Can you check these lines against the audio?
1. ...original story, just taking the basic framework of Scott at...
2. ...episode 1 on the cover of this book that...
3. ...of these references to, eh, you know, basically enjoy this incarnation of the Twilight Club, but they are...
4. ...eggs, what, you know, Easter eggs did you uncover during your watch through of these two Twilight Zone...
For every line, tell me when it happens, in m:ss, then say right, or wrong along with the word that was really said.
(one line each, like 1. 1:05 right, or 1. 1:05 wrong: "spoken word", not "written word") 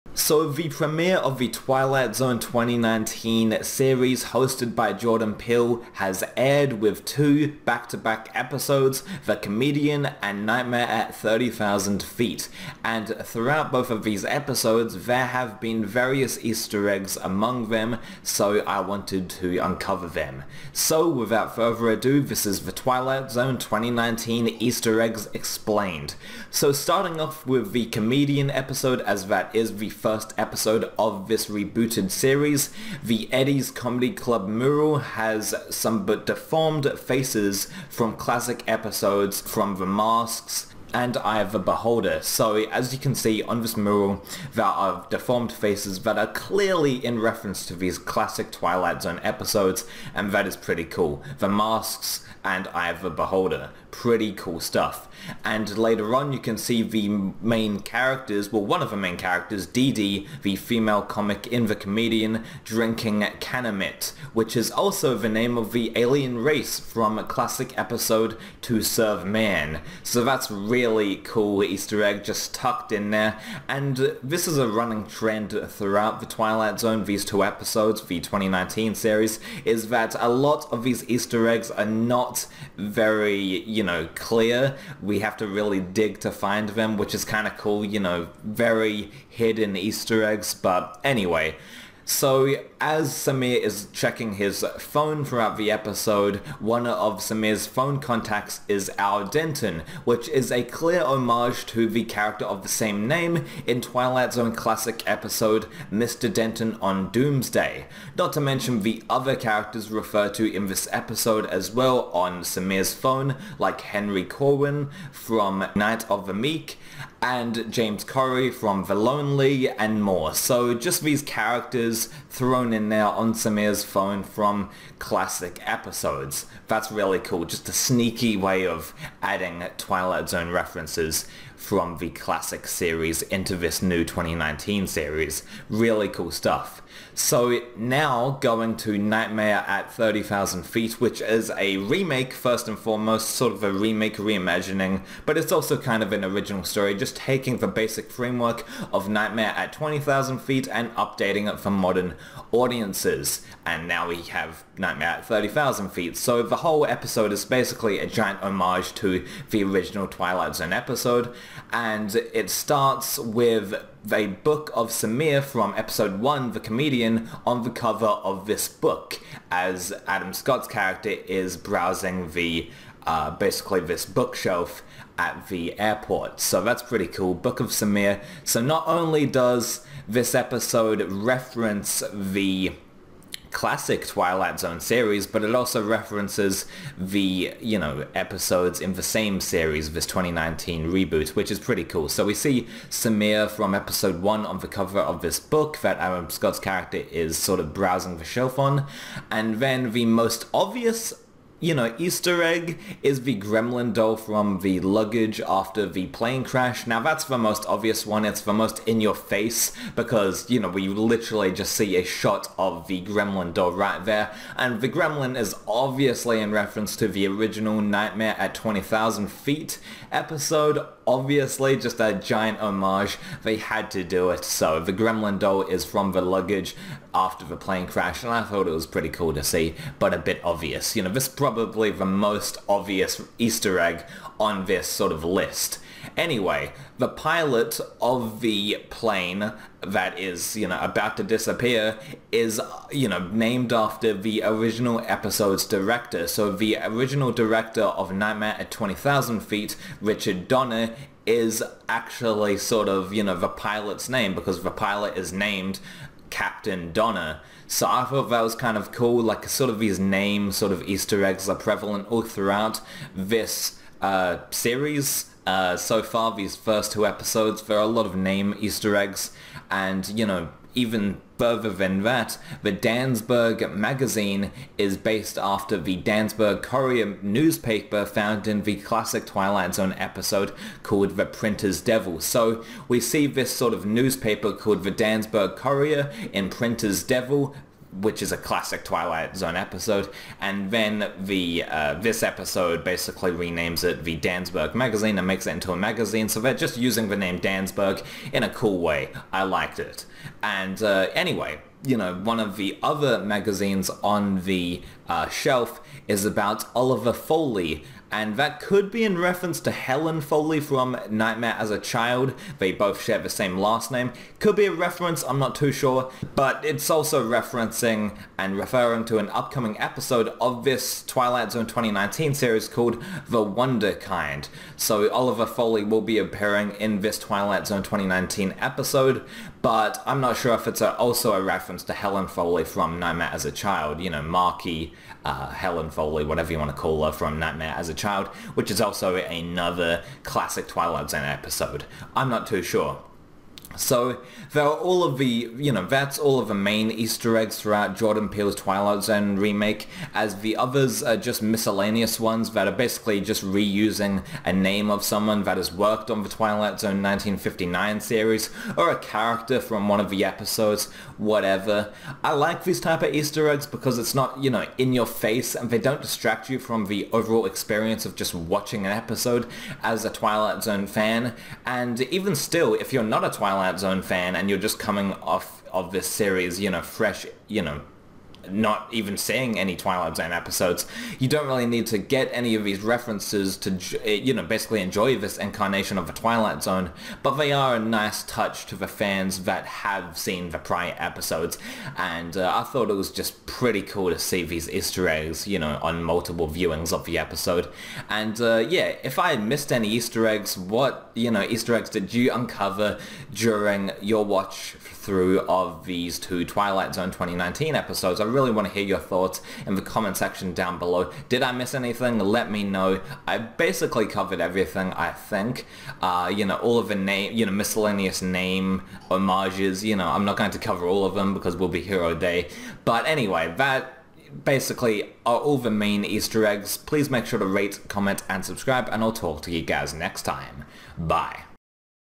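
1. 2:26 wrong: "Nightmare", not "Scott"
2. 3:13 right
3. 6:22 wrong: "Zone", not "Club"
4. 6:40 right.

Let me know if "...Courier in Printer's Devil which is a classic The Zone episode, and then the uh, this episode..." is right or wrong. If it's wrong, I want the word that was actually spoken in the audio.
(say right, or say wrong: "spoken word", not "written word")
wrong: "Twilight", not "The".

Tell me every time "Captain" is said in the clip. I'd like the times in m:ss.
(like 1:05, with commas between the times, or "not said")
4:16.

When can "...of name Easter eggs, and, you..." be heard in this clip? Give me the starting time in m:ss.
4:28.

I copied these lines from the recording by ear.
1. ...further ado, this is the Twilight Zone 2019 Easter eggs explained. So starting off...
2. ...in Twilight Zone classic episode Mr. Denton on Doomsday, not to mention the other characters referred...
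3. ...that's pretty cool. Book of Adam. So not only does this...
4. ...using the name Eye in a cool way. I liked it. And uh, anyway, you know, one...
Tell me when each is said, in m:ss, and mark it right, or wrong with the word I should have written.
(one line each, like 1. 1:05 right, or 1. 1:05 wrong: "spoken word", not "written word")
1. 0:21 right
2. 1:43 right
3. 2:56 wrong: "Samir", not "Adam"
4. 4:56 wrong: "Dansberg", not "Eye".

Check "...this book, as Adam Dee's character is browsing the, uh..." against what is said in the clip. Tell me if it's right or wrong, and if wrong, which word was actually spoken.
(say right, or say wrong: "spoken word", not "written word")
wrong: "Scott", not "Dee".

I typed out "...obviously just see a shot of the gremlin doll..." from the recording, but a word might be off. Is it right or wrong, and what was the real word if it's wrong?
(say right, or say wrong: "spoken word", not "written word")
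wrong: "literally", not "obviously".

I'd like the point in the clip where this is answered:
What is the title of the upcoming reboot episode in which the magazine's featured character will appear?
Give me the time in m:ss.
5:23.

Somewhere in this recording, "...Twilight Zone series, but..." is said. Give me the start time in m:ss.
3:04.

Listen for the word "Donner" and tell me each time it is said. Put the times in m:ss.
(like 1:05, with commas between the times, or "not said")
4:10, 4:16.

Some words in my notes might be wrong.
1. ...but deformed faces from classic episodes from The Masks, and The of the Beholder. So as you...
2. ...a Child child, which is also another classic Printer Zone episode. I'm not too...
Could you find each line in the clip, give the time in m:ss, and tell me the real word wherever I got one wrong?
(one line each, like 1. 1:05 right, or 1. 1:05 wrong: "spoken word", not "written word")
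1. 0:36 wrong: "Eye", not "The"
2. 5:37 wrong: "Twilight", not "Printer".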